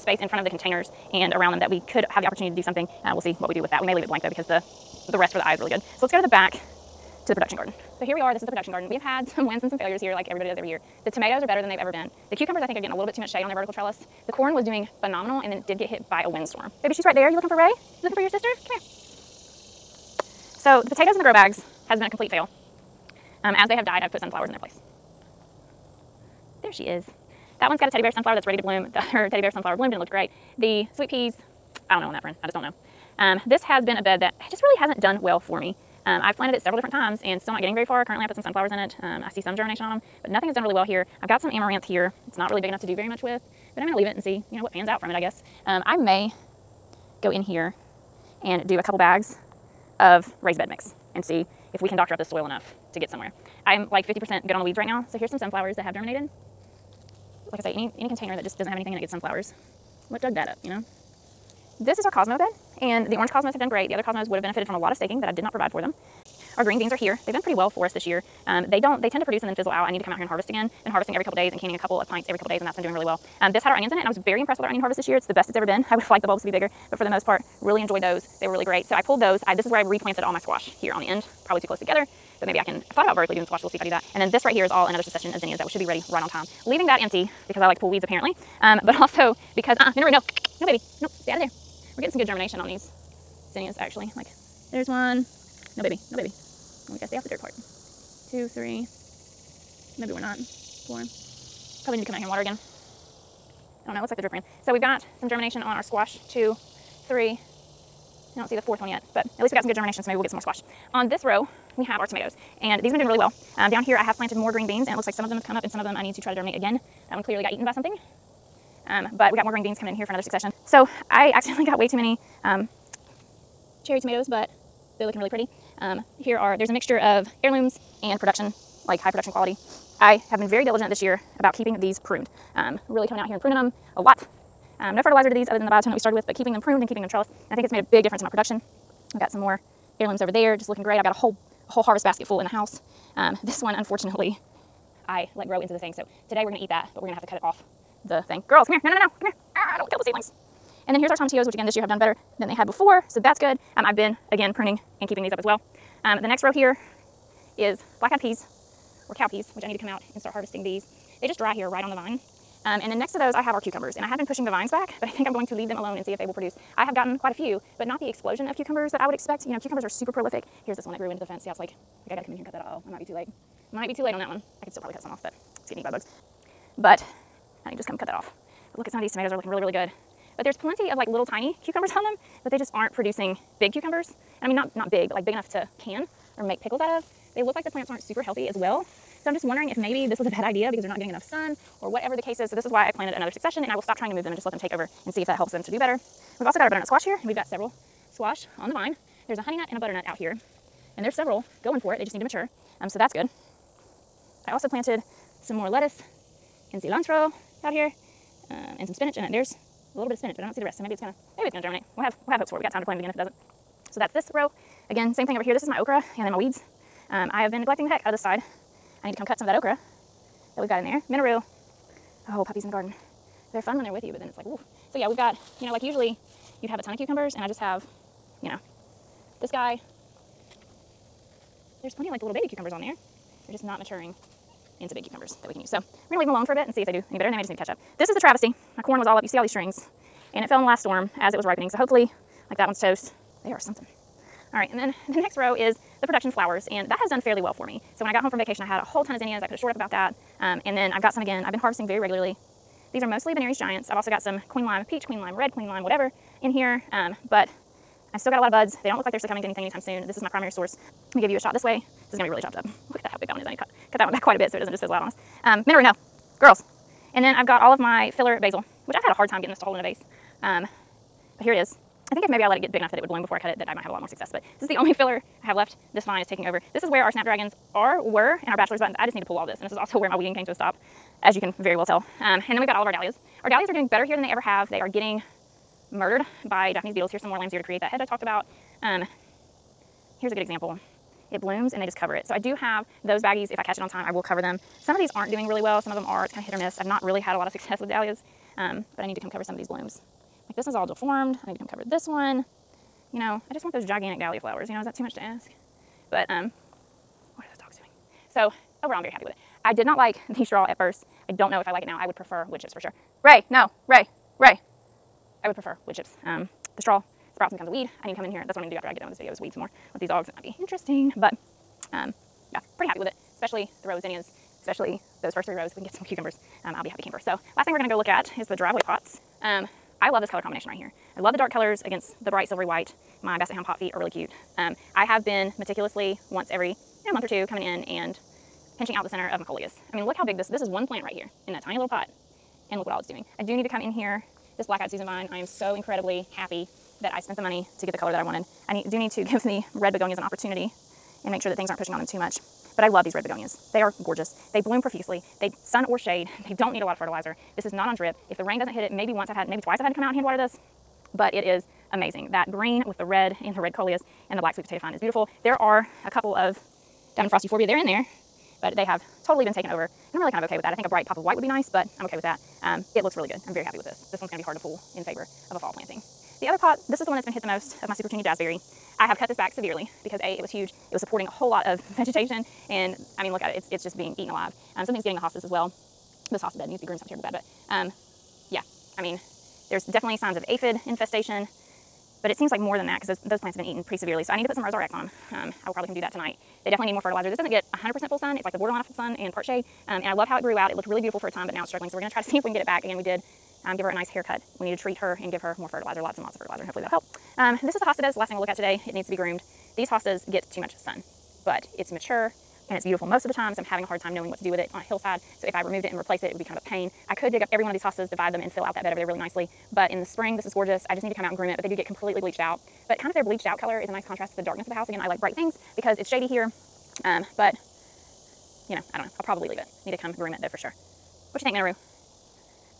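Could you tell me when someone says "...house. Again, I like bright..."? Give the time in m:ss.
7:04.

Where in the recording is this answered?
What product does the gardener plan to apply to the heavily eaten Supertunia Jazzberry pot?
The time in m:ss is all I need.
6:34.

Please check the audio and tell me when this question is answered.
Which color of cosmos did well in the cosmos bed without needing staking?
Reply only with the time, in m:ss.
1:03.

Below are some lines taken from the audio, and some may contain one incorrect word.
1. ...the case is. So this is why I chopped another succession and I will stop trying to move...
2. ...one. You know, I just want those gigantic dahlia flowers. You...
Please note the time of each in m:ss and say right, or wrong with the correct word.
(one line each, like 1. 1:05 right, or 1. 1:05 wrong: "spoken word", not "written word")
1. 3:12 wrong: "planted", not "chopped"
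2. 5:02 right.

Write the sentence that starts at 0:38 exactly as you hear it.
Currently I put some sunflowers in it.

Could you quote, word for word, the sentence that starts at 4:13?
I've also got some Queen Lime Peach, Queen Lime Red, Queen Lime whatever in here.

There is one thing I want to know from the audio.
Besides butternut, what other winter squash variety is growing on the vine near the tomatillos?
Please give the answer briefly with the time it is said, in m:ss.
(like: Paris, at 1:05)
honey nut, at 3:19.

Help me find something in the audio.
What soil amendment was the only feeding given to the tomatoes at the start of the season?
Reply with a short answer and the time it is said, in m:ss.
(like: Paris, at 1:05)
biotone, at 2:15.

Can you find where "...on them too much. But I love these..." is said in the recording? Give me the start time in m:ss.
5:51.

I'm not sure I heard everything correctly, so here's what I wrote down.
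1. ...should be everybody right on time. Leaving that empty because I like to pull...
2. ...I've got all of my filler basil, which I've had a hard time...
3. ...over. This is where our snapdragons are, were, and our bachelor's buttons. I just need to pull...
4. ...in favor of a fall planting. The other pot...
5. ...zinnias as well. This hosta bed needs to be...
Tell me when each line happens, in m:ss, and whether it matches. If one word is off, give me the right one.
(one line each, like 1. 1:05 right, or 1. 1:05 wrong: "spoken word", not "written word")
1. 1:25 wrong: "ready", not "everybody"
2. 4:27 right
3. 4:36 right
4. 6:14 right
5. 6:25 wrong: "hostas", not "zinnias".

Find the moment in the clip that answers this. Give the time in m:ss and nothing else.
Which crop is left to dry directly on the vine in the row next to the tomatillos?
2:38.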